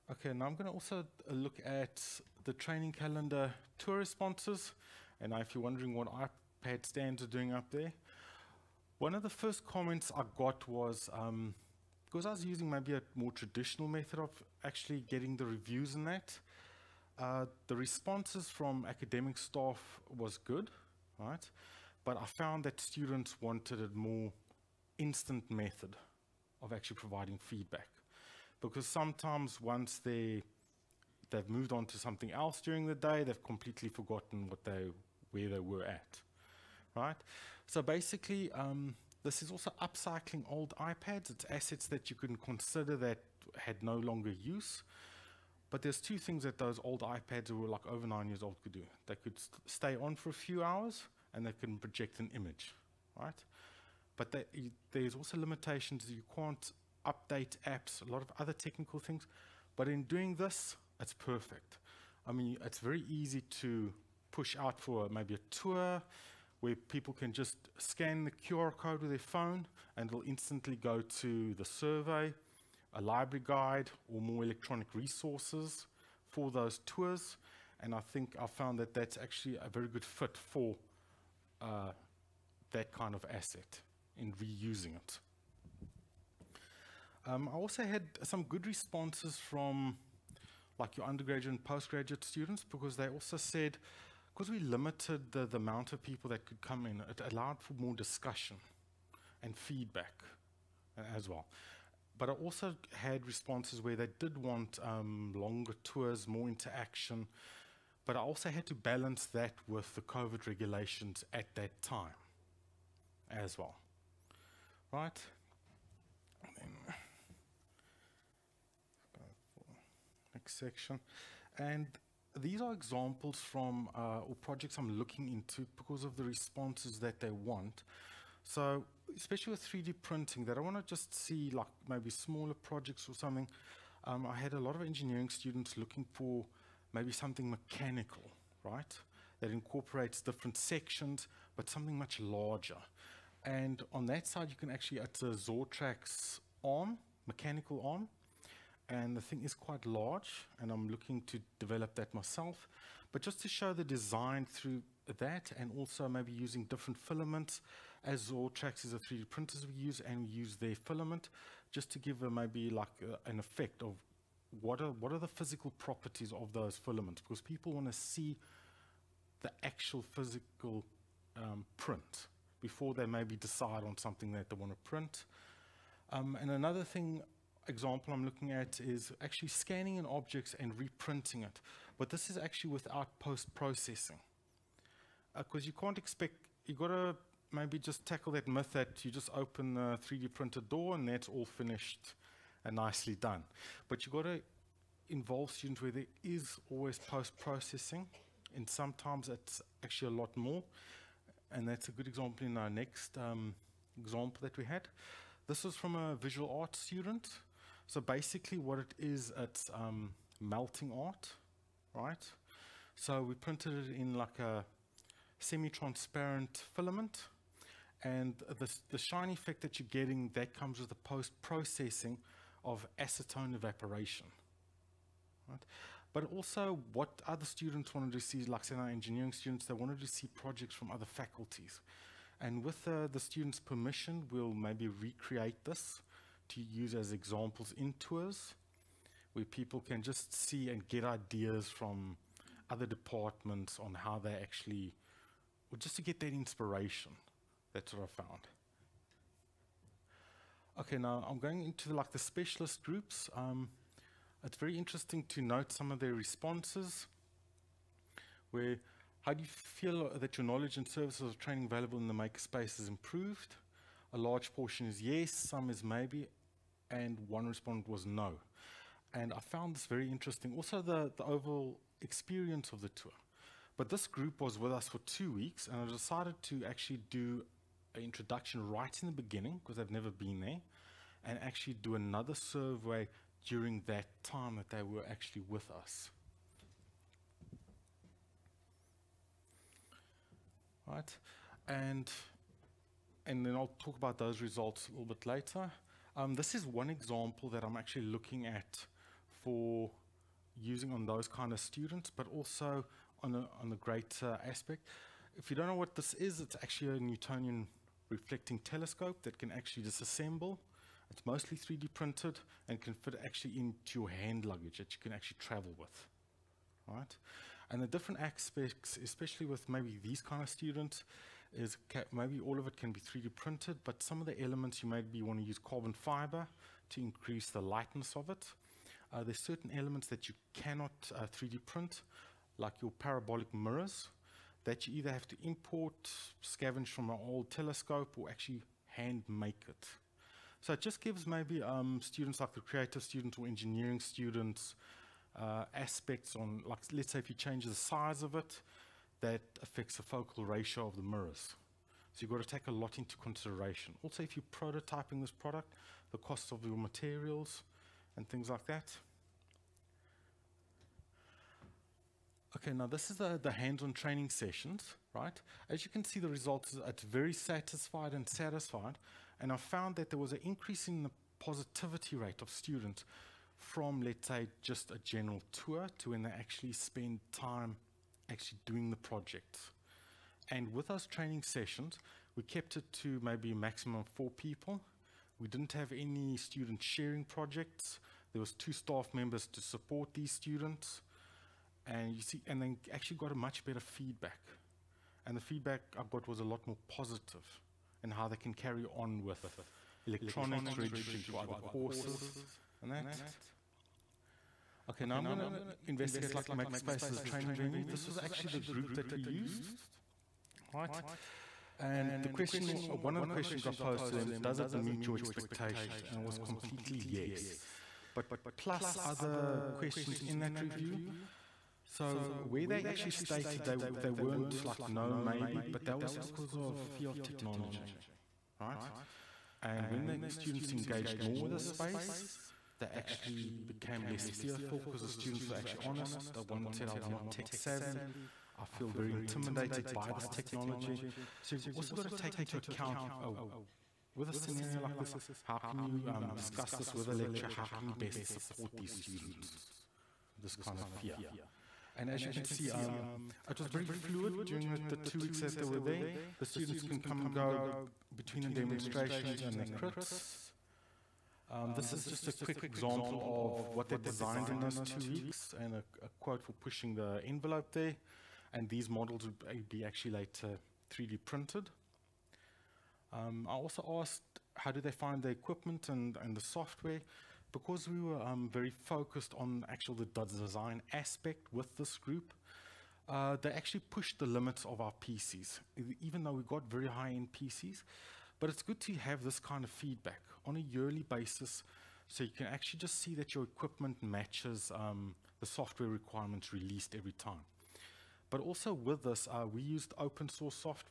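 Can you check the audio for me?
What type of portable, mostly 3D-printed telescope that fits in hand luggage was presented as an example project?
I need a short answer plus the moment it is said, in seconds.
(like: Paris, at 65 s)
Newtonian reflecting telescope, at 306 s.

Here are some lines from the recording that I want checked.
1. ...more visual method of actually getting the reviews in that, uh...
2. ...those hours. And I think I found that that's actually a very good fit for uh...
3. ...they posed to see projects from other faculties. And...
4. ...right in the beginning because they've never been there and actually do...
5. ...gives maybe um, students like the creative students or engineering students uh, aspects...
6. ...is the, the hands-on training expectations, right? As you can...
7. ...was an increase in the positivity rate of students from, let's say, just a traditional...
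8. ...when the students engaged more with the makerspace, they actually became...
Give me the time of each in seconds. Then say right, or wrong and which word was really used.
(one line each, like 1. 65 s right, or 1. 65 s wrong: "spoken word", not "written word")
1. 13 s wrong: "traditional", not "visual"
2. 76 s wrong: "tours", not "hours"
3. 229 s wrong: "wanted", not "posed"
4. 278 s right
5. 340 s right
6. 363 s wrong: "sessions", not "expectations"
7. 370 s wrong: "general", not "traditional"
8. 429 s wrong: "space", not "makerspace".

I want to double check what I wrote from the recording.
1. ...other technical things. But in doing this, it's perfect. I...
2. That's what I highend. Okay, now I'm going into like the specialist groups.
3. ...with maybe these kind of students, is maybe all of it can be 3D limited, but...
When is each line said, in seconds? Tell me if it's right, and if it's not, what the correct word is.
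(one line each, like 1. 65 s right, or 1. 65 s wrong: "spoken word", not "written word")
1. 58 s right
2. 247 s wrong: "found", not "highend"
3. 319 s wrong: "printed", not "limited".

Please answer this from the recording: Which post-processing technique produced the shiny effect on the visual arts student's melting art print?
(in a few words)
acetone evaporation.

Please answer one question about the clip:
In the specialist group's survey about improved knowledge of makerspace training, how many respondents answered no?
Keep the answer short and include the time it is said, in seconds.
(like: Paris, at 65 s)
1, at 267 s.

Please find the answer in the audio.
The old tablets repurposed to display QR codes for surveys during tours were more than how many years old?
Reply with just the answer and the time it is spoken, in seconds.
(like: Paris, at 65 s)
9, at 48 s.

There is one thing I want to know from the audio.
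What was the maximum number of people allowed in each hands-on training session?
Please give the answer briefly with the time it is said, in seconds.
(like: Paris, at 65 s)
4, at 384 s.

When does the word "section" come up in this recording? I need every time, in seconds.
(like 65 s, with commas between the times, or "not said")
120 s, 140 s.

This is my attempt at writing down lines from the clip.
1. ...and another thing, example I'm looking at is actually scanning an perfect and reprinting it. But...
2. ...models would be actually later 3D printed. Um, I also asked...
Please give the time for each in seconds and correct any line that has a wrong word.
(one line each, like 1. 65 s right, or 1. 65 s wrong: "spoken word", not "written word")
1. 176 s wrong: "object", not "perfect"
2. 468 s right.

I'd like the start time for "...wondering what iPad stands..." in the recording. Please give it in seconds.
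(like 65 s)
5 s.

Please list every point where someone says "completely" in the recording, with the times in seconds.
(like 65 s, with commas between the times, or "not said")
33 s, 416 s.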